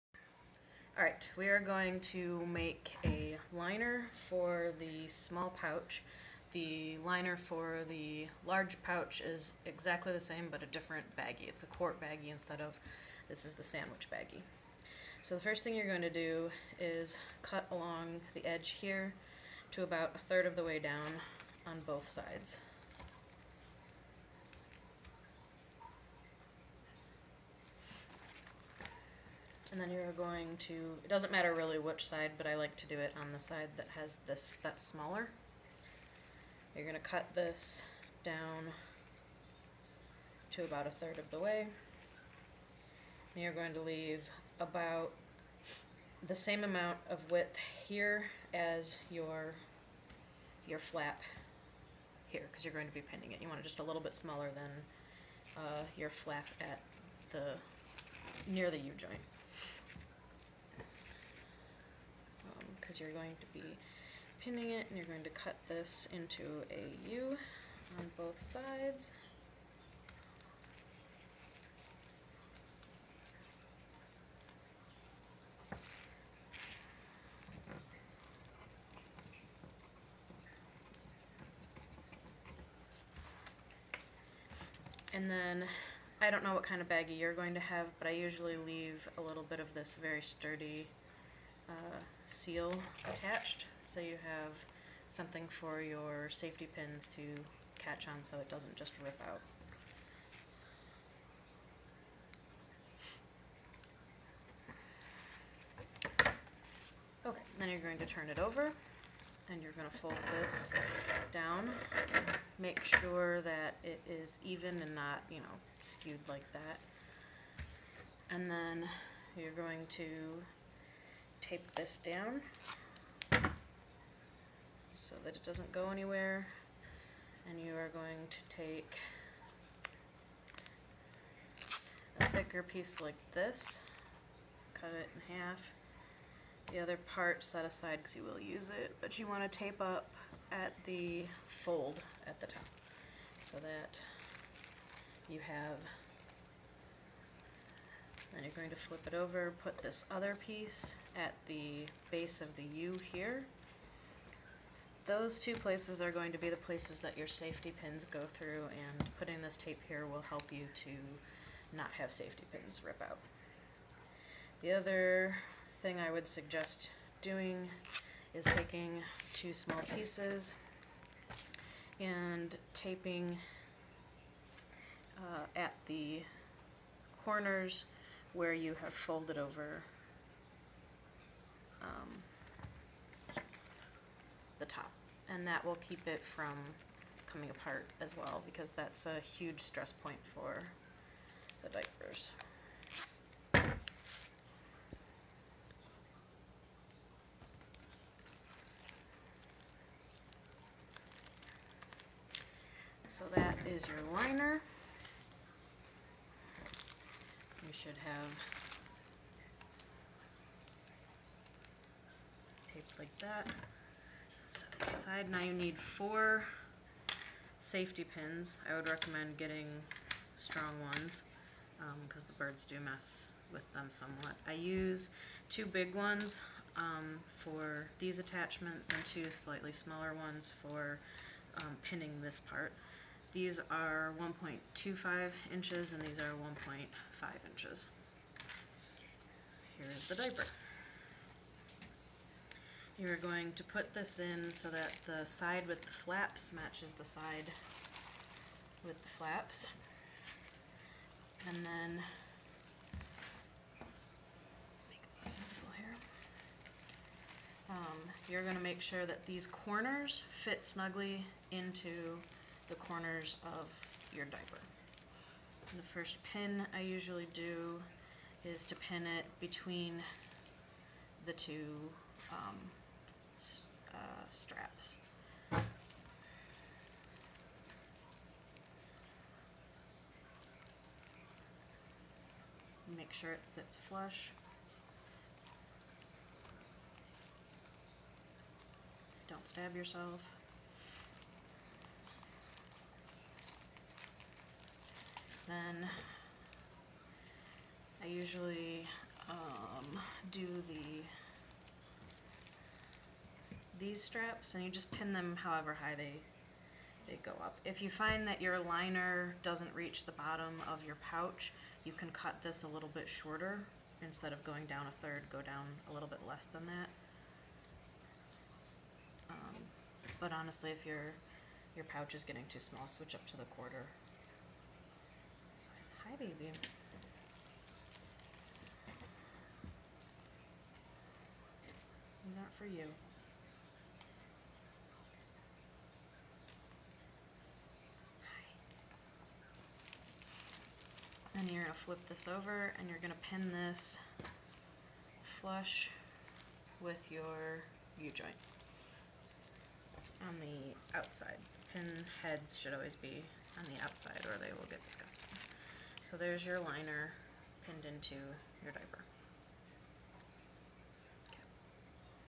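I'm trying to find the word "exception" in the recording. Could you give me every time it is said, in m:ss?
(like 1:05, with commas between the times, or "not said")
not said.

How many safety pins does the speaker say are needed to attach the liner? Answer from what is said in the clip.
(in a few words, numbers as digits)
4.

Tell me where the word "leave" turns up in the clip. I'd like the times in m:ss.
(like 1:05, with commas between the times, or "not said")
0:43, 1:28.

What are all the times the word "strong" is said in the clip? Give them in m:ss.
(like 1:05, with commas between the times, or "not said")
3:40.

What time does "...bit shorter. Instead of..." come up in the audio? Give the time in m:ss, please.
5:12.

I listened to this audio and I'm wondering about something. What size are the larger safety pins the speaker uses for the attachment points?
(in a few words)
1.5 inches.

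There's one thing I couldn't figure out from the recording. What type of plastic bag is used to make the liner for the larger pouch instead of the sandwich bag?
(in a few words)
quart baggie.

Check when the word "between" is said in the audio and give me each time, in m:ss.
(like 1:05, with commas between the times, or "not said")
4:29.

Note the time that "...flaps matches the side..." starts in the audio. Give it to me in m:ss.
4:05.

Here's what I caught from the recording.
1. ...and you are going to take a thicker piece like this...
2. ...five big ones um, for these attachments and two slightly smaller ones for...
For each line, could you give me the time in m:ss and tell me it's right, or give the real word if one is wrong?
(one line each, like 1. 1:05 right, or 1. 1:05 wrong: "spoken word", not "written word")
1. 2:07 right
2. 3:45 wrong: "two", not "five".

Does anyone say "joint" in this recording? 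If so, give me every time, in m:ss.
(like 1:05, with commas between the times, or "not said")
0:58, 5:47.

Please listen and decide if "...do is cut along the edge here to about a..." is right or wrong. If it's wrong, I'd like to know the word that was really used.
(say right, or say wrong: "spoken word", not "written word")
right.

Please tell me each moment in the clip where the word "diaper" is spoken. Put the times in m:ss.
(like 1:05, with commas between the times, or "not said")
3:11, 4:00, 4:24, 5:58.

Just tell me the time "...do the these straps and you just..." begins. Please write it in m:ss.
5:00.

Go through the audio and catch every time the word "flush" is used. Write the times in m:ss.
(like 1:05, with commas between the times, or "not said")
4:43, 5:45.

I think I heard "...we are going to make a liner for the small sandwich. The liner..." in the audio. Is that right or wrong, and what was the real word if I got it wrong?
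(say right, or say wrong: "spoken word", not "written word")
wrong: "pouch", not "sandwich".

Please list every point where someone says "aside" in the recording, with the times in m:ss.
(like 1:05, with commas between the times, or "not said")
2:17, 3:34.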